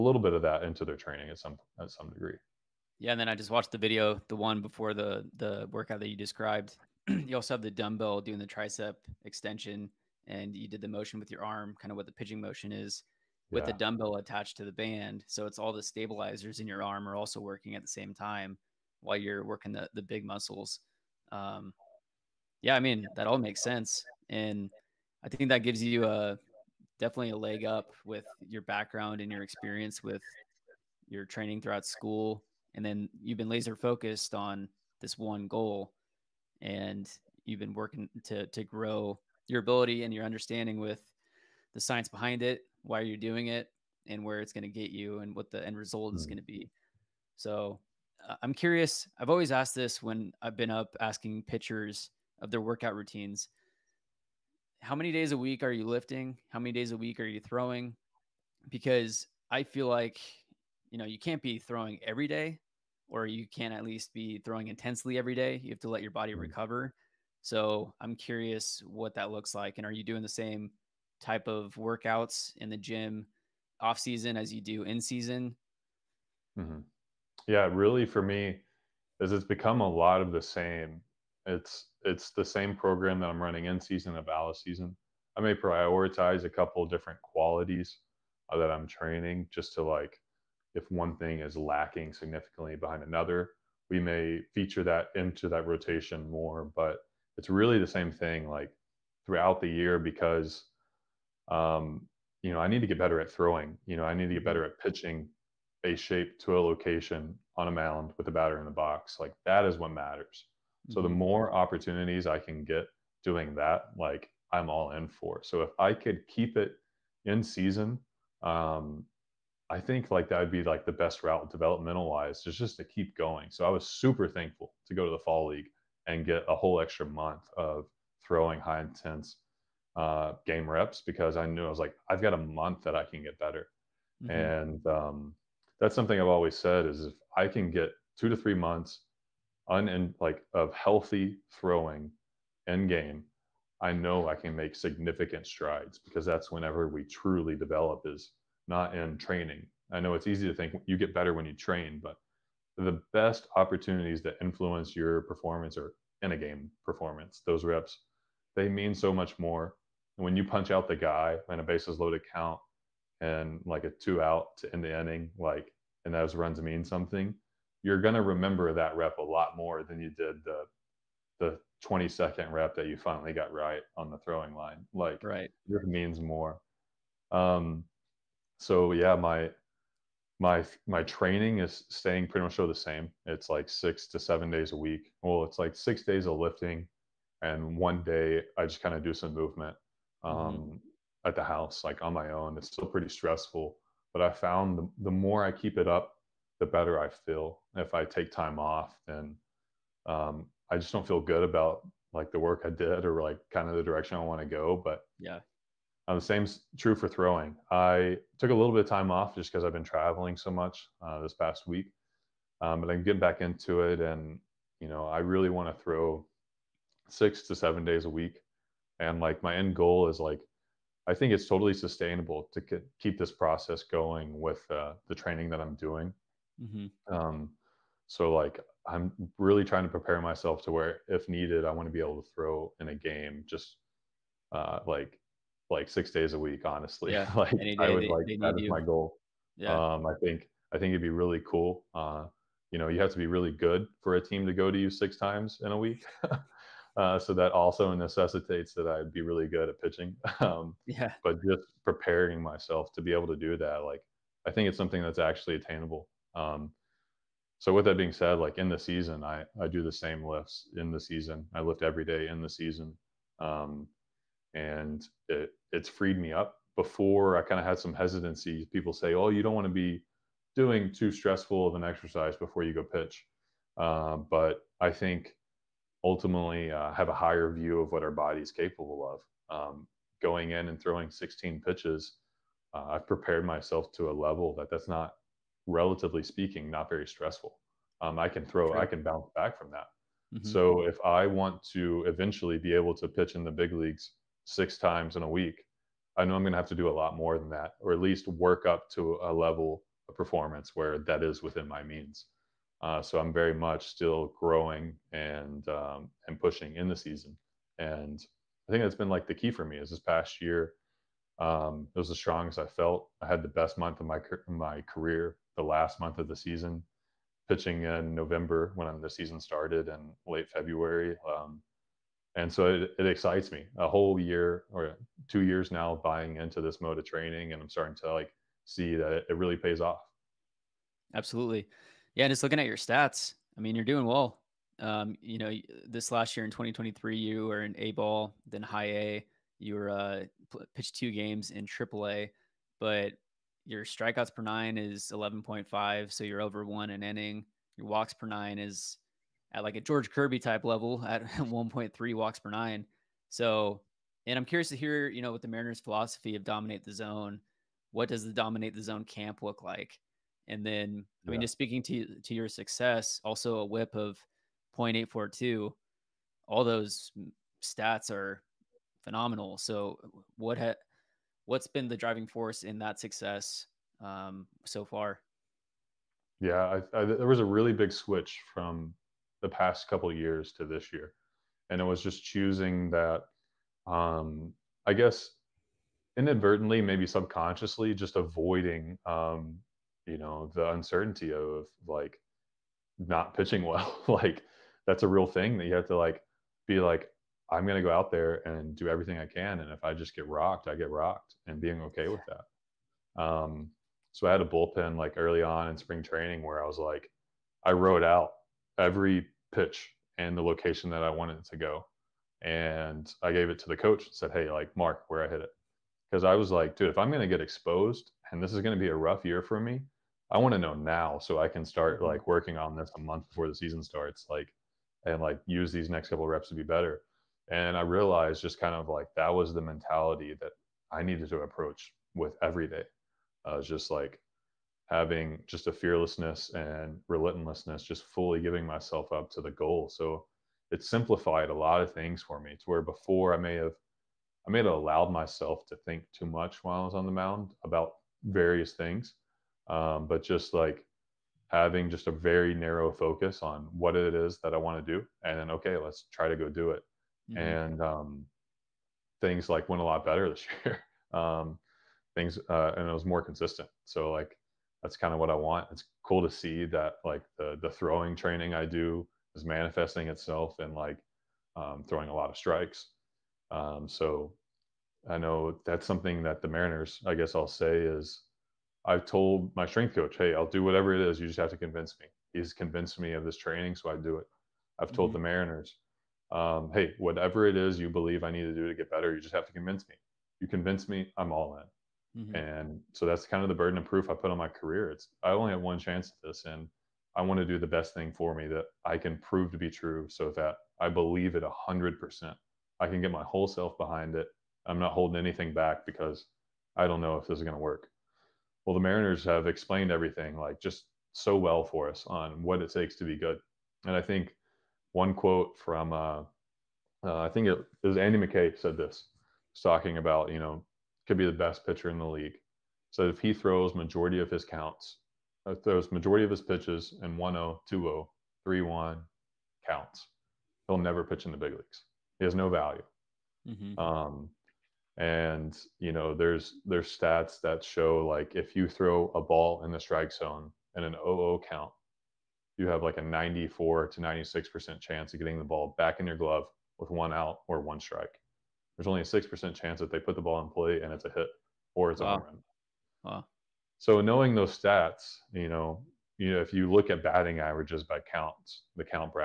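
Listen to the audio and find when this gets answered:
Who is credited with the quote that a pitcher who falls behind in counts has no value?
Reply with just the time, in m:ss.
8:37.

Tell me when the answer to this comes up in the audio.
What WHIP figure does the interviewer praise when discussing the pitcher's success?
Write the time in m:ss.
6:04.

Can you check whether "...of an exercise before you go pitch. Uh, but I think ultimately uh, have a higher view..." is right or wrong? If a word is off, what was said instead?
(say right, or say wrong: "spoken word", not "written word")
right.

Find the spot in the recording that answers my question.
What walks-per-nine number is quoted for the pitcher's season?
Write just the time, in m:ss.
5:51.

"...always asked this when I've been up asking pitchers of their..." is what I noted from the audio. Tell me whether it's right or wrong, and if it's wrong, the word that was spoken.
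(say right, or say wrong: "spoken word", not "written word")
right.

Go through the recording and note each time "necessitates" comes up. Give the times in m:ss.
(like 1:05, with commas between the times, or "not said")
4:07.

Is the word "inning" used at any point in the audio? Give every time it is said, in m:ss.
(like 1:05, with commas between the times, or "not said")
2:44, 5:47.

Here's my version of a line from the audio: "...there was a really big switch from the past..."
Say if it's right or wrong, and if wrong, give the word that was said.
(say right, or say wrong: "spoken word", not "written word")
right.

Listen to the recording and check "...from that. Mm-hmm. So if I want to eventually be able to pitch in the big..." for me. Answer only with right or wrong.
right.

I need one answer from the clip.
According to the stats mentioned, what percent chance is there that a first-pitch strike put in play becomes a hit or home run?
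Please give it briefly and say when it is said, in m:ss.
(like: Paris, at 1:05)
6%, at 9:09.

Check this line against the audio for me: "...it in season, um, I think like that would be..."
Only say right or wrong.
right.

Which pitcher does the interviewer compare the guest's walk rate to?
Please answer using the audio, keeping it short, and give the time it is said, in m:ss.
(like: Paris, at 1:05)
George Kirby, at 5:49.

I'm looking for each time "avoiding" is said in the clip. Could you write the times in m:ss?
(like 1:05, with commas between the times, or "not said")
6:28.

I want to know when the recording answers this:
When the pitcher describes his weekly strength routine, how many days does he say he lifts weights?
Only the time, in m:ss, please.
3:05.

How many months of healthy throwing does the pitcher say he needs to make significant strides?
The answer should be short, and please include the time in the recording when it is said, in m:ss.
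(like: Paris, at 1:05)
2 to 3, at 2:18.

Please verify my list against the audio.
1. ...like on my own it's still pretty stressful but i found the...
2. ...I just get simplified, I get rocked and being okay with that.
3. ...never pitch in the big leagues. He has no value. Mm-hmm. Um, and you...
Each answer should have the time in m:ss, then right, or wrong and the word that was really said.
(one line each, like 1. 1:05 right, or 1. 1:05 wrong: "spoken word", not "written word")
1. 3:11 right
2. 6:39 wrong: "rocked", not "simplified"
3. 8:50 right.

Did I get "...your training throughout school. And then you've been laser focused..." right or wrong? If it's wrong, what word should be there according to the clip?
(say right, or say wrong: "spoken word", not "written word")
right.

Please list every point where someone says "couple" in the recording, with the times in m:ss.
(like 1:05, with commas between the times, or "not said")
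1:26, 6:19, 7:06.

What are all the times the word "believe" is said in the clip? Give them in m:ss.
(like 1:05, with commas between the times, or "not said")
8:07, 8:20.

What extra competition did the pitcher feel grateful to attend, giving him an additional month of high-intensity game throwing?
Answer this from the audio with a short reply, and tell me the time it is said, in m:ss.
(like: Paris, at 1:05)
the fall league, at 2:05.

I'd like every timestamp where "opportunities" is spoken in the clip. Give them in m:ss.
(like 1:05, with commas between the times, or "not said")
1:51, 2:33.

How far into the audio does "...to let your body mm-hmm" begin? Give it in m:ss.
1:05.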